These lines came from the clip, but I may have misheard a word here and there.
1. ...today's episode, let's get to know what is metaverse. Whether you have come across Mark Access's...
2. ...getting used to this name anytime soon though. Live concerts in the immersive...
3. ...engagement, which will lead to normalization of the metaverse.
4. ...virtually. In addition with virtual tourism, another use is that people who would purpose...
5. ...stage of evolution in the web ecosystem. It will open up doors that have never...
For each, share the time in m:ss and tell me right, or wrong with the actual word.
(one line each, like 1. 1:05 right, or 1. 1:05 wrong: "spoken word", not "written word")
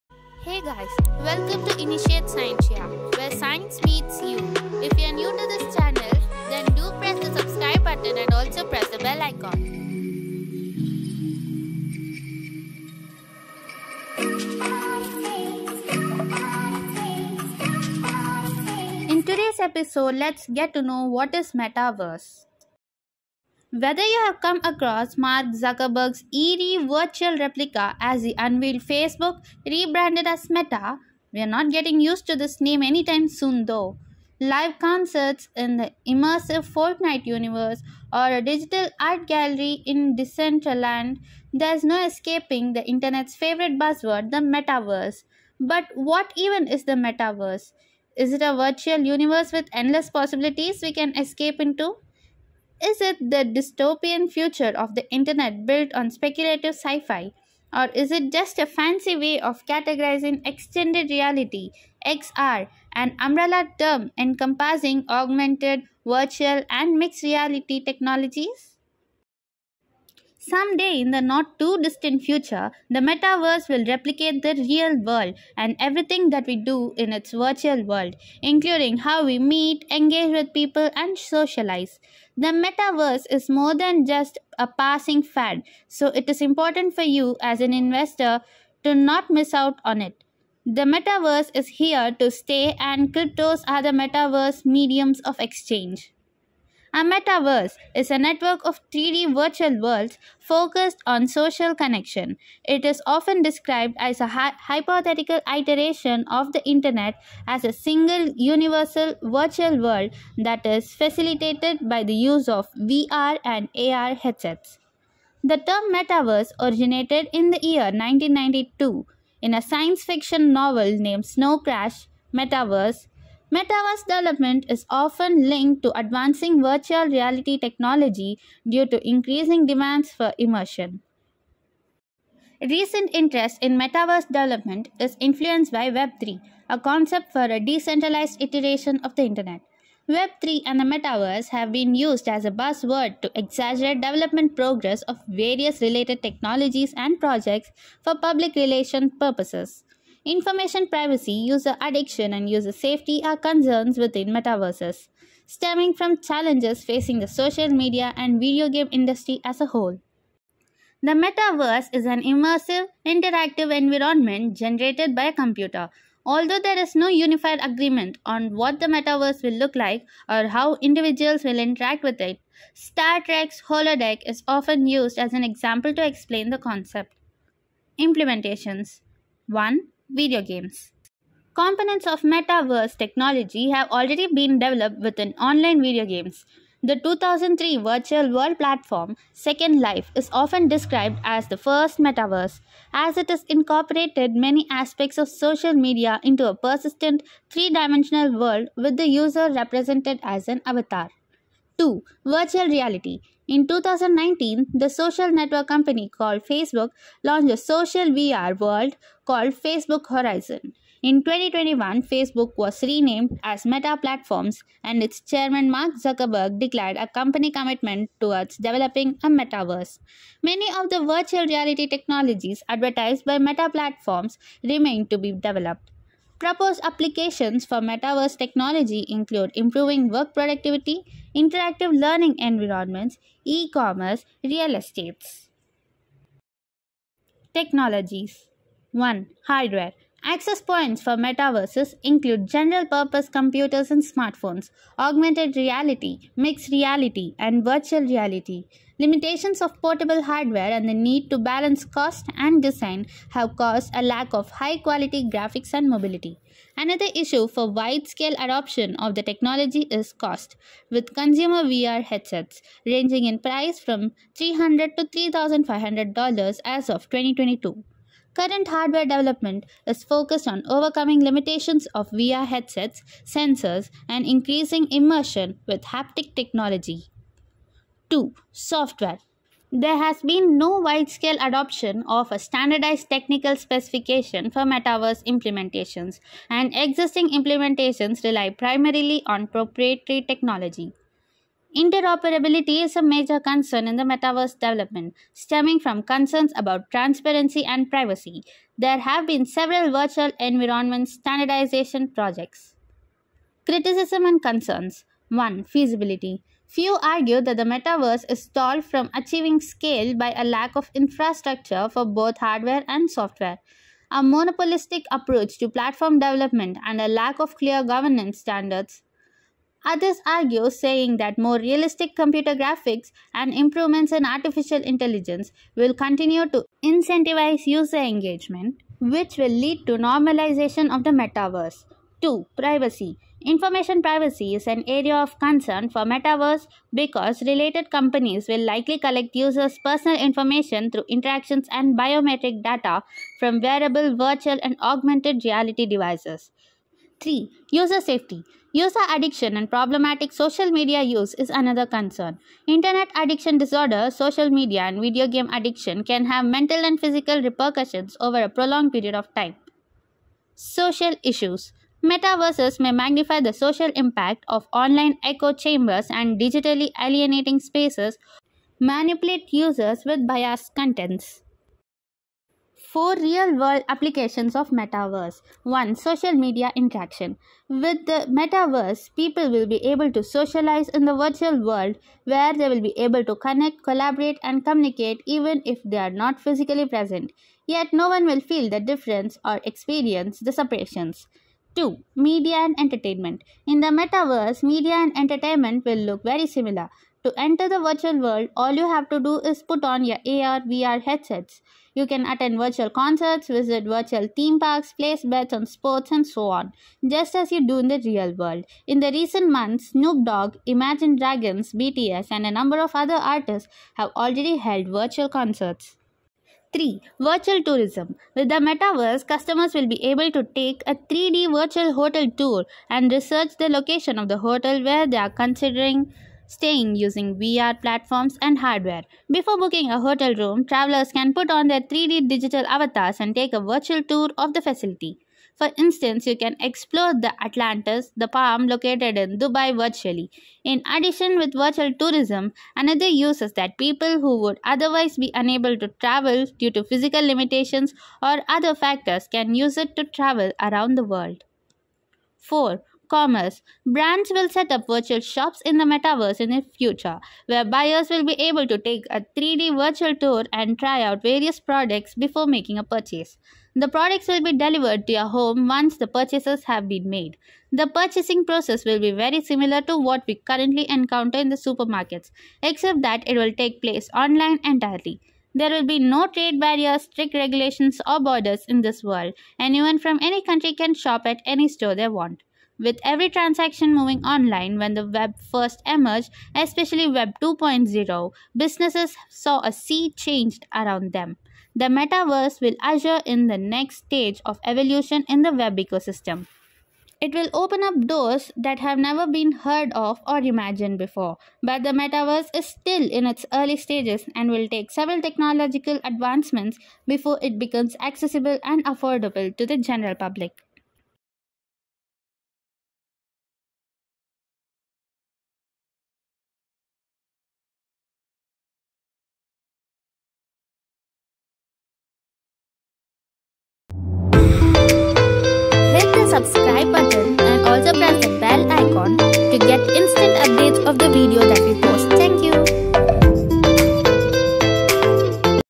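1. 0:19 wrong: "Zuckerberg", not "Access"
2. 0:31 right
3. 5:27 right
4. 7:19 wrong: "otherwise", not "purpose"
5. 8:13 right.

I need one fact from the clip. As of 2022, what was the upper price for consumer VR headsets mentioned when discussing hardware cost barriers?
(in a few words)
$3,500.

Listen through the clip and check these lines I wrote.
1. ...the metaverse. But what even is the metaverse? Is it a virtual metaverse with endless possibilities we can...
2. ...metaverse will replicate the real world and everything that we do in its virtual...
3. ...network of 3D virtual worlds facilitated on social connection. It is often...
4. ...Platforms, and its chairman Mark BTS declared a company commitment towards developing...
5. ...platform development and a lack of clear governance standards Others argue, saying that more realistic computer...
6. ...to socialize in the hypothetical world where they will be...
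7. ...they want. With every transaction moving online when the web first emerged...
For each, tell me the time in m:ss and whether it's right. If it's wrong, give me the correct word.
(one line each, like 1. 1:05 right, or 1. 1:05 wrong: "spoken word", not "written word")
1. 0:44 wrong: "universe", not "metaverse"
2. 1:12 right
3. 1:38 wrong: "focused", not "facilitated"
4. 3:33 wrong: "Zuckerberg", not "BTS"
5. 5:15 right
6. 6:20 wrong: "virtual", not "hypothetical"
7. 8:01 right.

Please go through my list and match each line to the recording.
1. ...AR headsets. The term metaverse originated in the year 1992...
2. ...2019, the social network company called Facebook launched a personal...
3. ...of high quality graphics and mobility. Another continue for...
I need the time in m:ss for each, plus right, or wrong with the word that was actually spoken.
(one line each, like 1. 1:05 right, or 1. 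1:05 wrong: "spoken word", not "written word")
1. 1:53 right
2. 3:23 wrong: "social", not "personal"
3. 4:14 wrong: "issue", not "continue".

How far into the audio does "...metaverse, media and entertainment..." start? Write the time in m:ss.
6:33.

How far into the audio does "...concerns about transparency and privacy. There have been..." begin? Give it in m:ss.
4:56.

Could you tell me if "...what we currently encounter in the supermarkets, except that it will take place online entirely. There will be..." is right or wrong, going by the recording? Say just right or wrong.
right.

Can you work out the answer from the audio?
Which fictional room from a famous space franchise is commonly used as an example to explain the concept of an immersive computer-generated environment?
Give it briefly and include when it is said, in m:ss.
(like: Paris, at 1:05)
Star Trek's holodeck, at 2:52.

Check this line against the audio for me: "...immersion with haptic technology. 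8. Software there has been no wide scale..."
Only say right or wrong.
wrong.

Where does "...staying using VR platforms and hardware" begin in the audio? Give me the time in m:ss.
7:06.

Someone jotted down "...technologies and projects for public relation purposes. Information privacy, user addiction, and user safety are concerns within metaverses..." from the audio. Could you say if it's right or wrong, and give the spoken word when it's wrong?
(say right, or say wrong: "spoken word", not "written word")
right.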